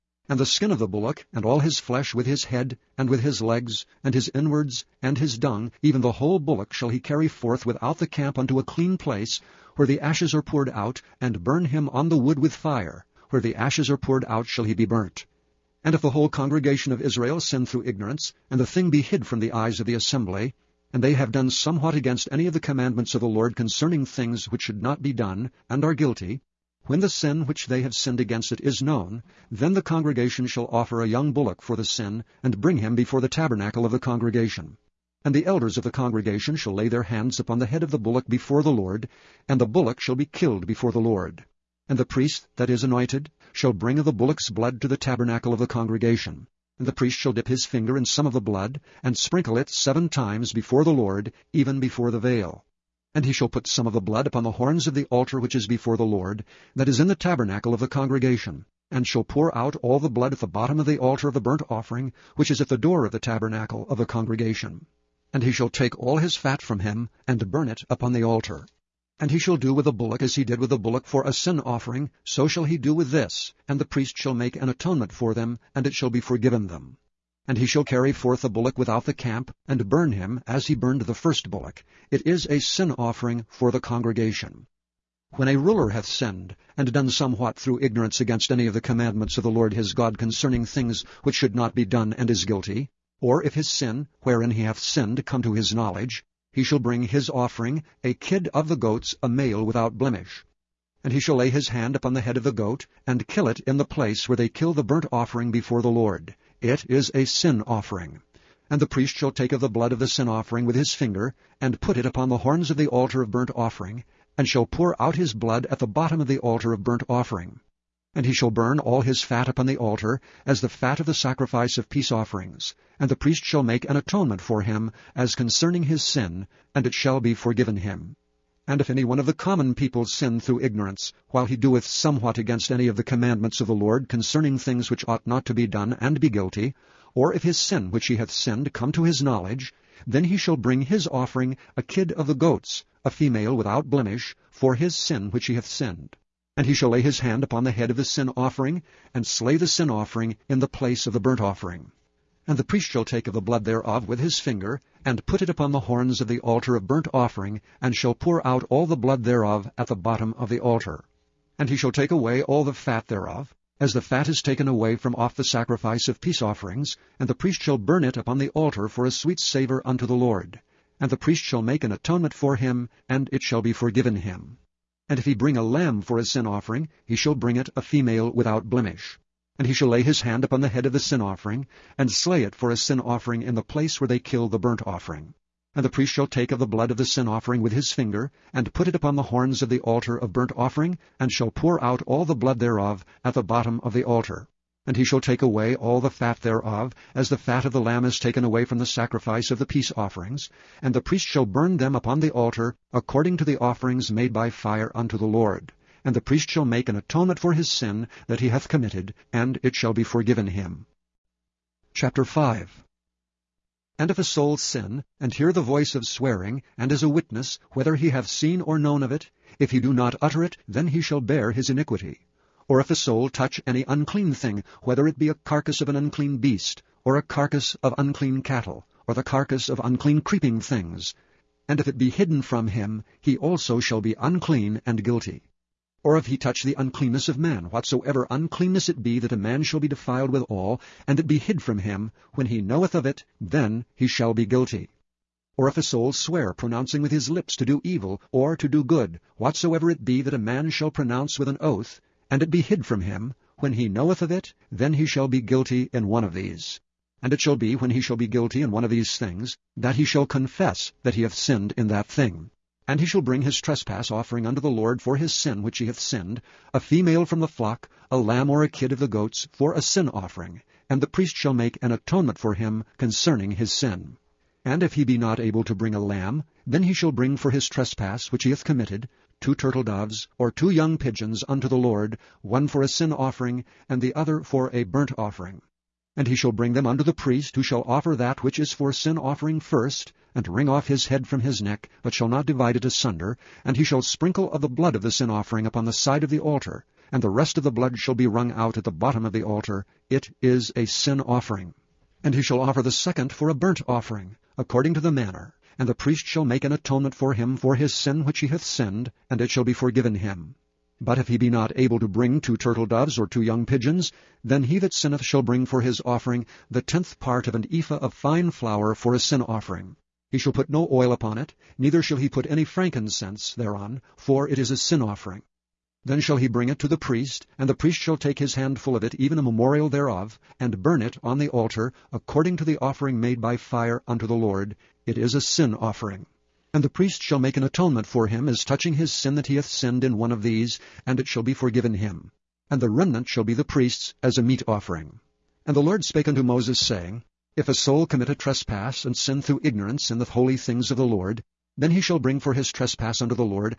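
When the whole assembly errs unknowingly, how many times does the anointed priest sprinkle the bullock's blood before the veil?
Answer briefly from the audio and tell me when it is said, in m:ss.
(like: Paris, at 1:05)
7, at 0:49.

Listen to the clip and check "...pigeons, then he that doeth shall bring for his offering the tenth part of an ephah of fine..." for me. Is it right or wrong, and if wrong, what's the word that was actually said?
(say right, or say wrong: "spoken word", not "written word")
wrong: "sinneth", not "doeth".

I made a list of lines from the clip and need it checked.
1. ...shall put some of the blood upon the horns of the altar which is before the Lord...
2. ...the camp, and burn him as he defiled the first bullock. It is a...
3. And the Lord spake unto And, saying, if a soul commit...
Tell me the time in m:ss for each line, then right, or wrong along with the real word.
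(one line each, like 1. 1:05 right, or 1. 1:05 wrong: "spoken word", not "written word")
1. 0:53 right
2. 1:19 wrong: "burned", not "defiled"
3. 5:45 wrong: "Moses", not "And".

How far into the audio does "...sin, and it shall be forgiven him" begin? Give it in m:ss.
2:06.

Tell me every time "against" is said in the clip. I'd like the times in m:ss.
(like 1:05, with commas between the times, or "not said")
0:21, 0:28, 1:28, 2:12.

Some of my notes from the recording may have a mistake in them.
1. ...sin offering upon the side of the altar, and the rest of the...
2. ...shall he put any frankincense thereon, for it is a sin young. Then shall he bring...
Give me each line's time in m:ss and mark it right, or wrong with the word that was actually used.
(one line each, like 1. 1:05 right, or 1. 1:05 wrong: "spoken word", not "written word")
1. 4:55 right
2. 5:22 wrong: "offering", not "young".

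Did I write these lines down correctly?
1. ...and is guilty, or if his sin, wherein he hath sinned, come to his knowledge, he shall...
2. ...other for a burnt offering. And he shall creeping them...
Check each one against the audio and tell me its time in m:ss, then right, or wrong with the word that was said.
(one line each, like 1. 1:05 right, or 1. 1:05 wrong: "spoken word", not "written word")
1. 1:32 right
2. 4:44 wrong: "bring", not "creeping".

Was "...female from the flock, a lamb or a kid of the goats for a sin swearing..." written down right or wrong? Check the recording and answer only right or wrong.
wrong.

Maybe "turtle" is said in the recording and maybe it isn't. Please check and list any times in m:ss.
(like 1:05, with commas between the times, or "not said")
4:39, 5:12.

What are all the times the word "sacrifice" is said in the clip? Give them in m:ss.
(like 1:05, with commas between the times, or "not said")
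2:01, 2:45, 3:18.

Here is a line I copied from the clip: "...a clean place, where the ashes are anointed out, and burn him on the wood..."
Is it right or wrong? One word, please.
wrong.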